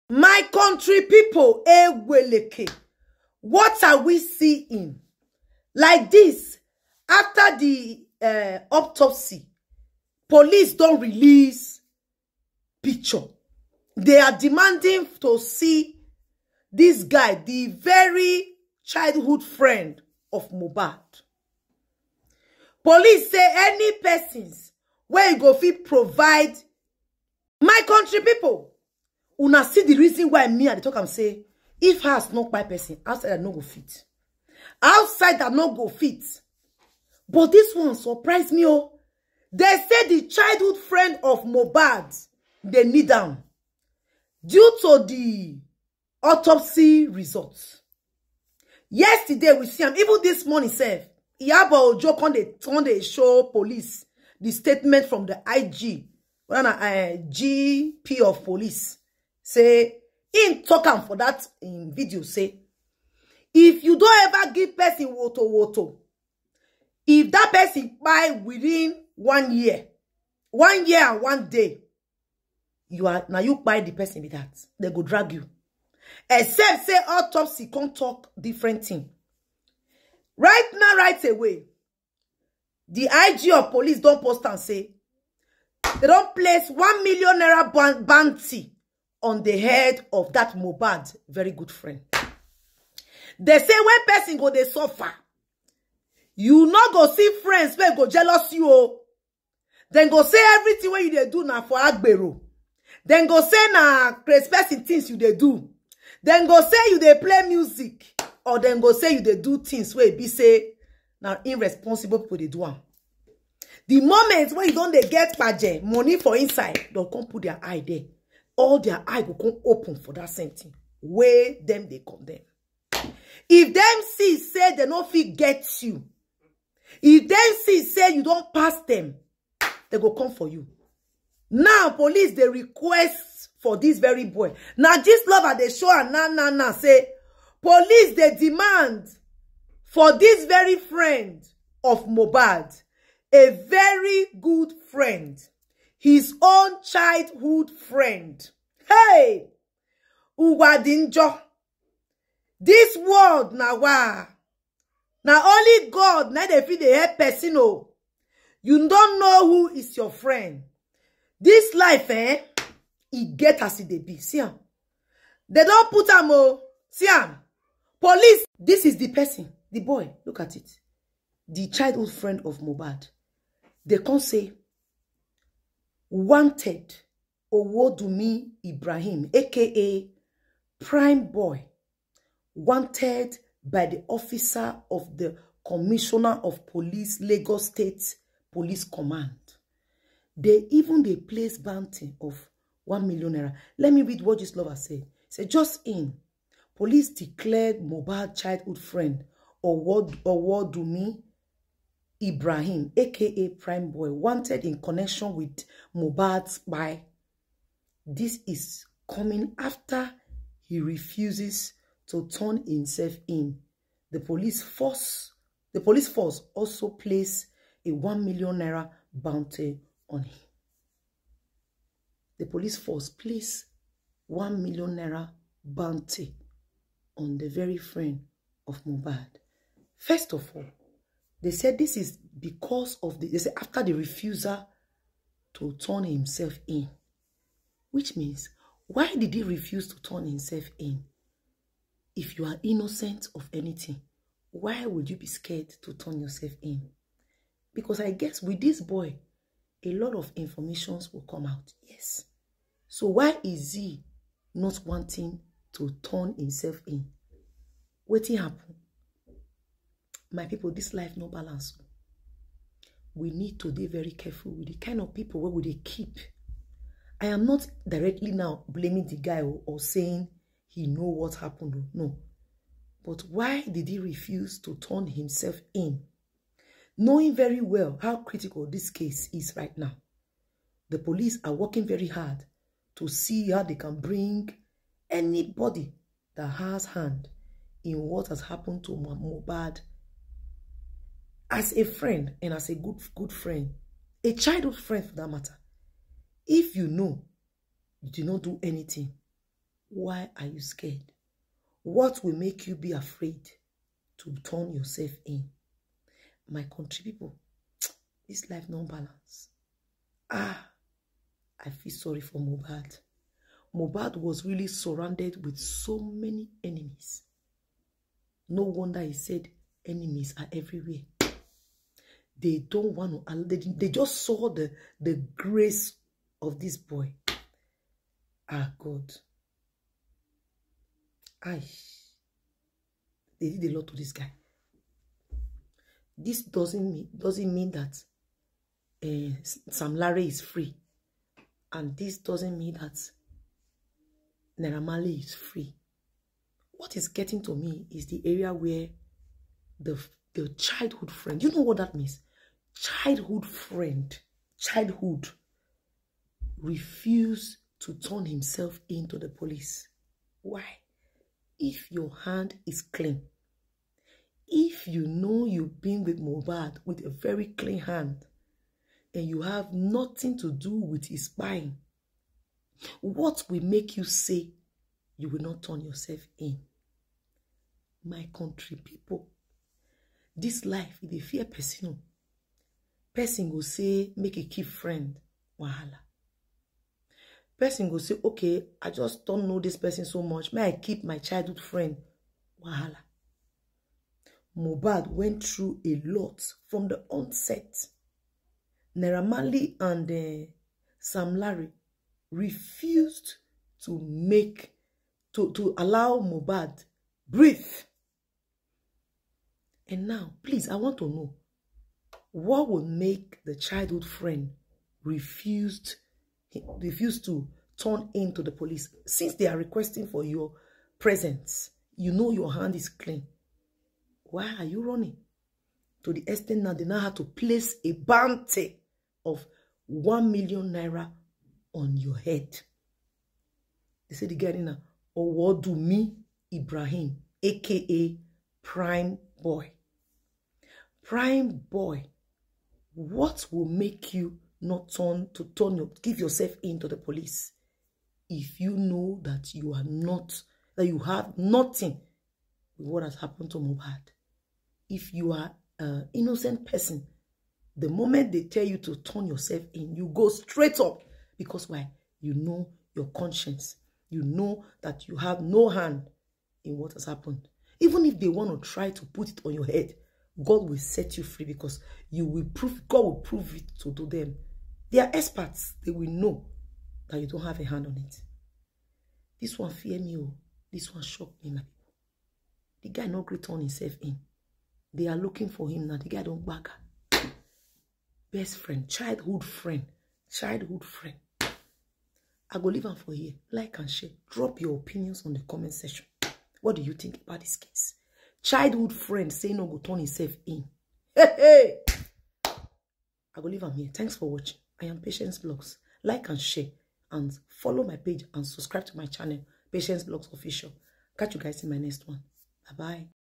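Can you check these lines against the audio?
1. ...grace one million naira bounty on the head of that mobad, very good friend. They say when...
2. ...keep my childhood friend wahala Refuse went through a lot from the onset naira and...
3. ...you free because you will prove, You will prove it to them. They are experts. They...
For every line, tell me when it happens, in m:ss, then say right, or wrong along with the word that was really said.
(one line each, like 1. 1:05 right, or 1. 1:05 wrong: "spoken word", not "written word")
1. 1:26 wrong: "place", not "grace"
2. 6:30 wrong: "Mobad", not "Refuse"
3. 7:51 wrong: "God", not "You".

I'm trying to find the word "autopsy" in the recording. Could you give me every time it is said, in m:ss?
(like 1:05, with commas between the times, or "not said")
0:08, 0:46, 1:17.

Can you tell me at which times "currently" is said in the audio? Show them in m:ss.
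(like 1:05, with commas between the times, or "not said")
not said.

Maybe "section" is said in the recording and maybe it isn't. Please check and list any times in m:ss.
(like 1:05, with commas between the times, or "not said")
8:15.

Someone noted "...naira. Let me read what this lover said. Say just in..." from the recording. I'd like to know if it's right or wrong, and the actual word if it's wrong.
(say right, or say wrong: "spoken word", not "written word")
right.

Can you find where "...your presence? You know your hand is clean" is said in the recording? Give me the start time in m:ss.
7:00.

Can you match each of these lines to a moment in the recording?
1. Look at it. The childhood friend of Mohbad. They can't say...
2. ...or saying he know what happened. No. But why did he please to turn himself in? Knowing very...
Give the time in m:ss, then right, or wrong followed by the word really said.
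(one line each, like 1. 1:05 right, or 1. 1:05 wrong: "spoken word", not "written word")
1. 2:50 right
2. 4:29 wrong: "refuse", not "please".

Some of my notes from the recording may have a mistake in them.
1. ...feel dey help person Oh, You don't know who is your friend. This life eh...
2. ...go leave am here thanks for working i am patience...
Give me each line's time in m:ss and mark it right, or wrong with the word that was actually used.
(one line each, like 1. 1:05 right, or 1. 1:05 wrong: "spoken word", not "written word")
1. 2:36 right
2. 8:23 wrong: "watching", not "working".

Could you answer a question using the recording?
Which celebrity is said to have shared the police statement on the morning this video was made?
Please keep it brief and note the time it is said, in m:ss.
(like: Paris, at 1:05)
Iyabo Ojo, at 0:51.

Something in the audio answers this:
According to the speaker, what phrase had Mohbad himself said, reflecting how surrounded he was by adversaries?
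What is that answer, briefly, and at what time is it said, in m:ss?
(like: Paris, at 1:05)
Enemies are everywhere, at 5:19.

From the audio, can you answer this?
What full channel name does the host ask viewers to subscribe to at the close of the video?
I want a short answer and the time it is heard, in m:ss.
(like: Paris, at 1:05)
Patience Blogs Official, at 8:29.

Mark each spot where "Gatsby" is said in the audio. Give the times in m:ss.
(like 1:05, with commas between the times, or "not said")
not said.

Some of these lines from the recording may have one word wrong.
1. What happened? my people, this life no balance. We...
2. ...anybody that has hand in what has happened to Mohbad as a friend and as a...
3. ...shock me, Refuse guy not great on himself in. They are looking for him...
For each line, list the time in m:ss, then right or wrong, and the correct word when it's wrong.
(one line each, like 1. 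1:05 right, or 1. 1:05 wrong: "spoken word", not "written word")
1. 4:18 right
2. 4:45 right
3. 8:01 wrong: "The", not "Refuse".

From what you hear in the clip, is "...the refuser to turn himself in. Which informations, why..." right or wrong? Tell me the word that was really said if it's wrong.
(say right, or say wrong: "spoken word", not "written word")
wrong: "means", not "informations".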